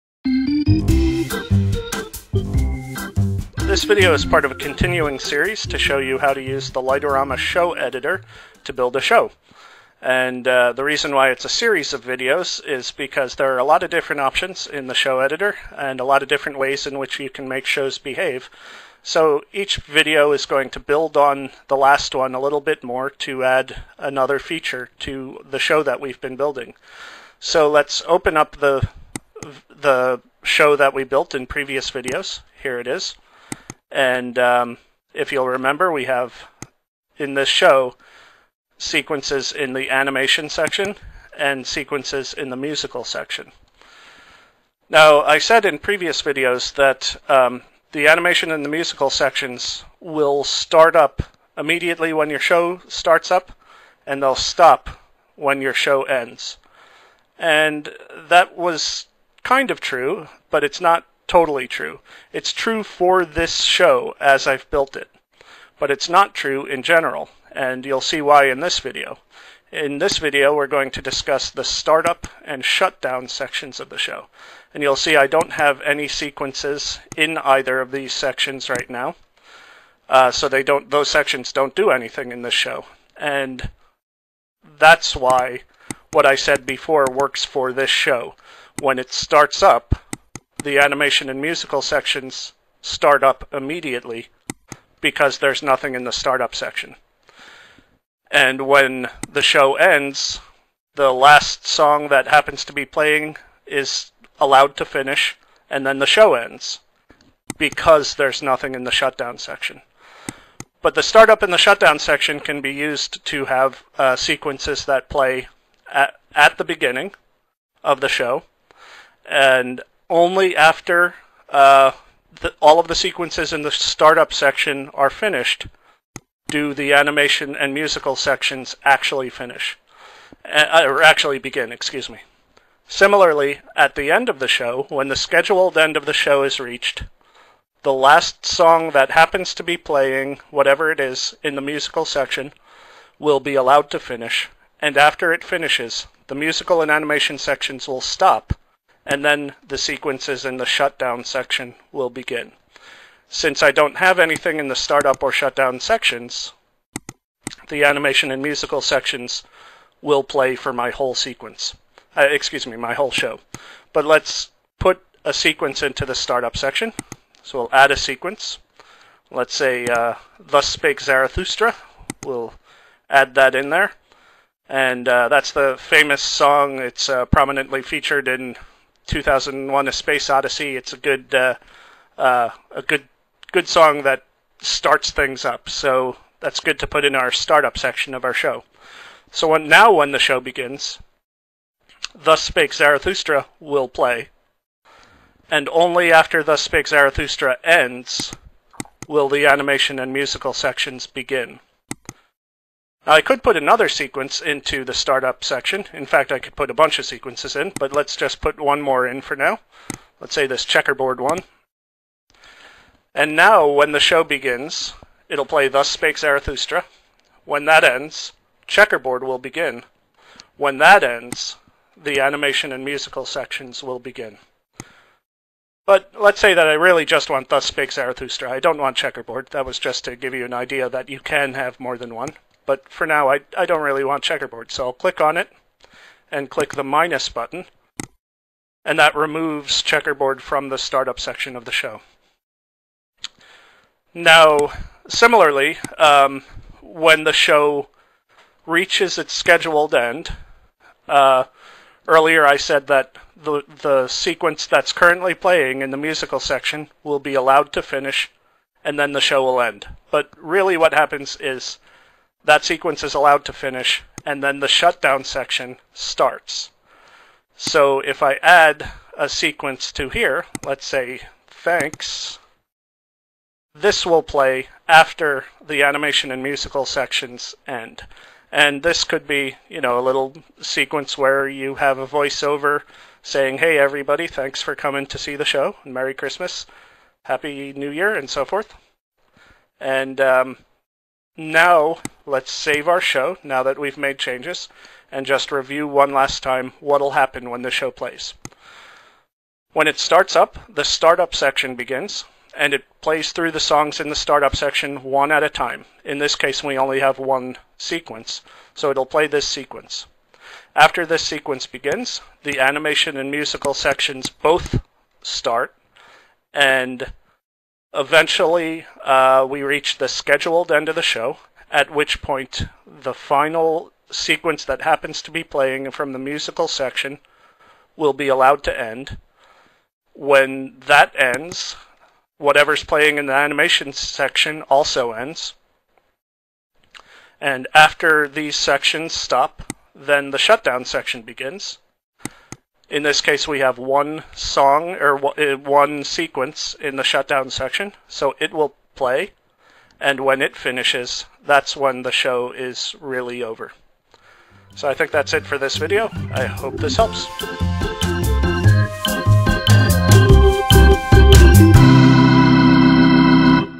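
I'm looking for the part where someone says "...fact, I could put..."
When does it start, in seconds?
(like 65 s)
206 s.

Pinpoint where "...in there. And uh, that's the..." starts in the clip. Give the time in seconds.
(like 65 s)
173 s.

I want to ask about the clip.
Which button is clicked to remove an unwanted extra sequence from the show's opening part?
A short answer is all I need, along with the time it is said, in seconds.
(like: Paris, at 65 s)
minus button, at 236 s.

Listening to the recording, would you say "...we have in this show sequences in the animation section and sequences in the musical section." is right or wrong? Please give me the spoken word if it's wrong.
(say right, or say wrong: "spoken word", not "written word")
right.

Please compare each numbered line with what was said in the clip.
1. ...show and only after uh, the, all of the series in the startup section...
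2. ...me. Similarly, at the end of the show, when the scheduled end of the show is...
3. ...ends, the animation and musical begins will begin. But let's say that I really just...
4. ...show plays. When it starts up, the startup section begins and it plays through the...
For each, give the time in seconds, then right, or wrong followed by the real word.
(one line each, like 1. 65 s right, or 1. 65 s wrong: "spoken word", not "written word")
1. 118 s wrong: "sequences", not "series"
2. 132 s right
3. 221 s wrong: "sections", not "begins"
4. 297 s right.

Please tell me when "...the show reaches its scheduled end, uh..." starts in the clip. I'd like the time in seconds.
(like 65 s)
247 s.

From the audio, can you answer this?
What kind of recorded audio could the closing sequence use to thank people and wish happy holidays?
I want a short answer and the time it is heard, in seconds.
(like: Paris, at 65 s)
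voiceover, at 282 s.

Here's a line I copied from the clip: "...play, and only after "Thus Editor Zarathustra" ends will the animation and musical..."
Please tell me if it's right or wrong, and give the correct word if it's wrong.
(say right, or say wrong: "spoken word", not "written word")
wrong: "Spake", not "Editor".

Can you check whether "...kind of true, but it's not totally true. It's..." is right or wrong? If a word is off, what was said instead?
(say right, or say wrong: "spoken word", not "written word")
right.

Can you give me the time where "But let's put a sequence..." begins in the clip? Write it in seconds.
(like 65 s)
163 s.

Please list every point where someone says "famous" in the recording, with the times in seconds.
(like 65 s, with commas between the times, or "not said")
175 s.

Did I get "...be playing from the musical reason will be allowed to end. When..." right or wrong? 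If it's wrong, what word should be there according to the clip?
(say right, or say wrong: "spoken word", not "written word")
wrong: "section", not "reason".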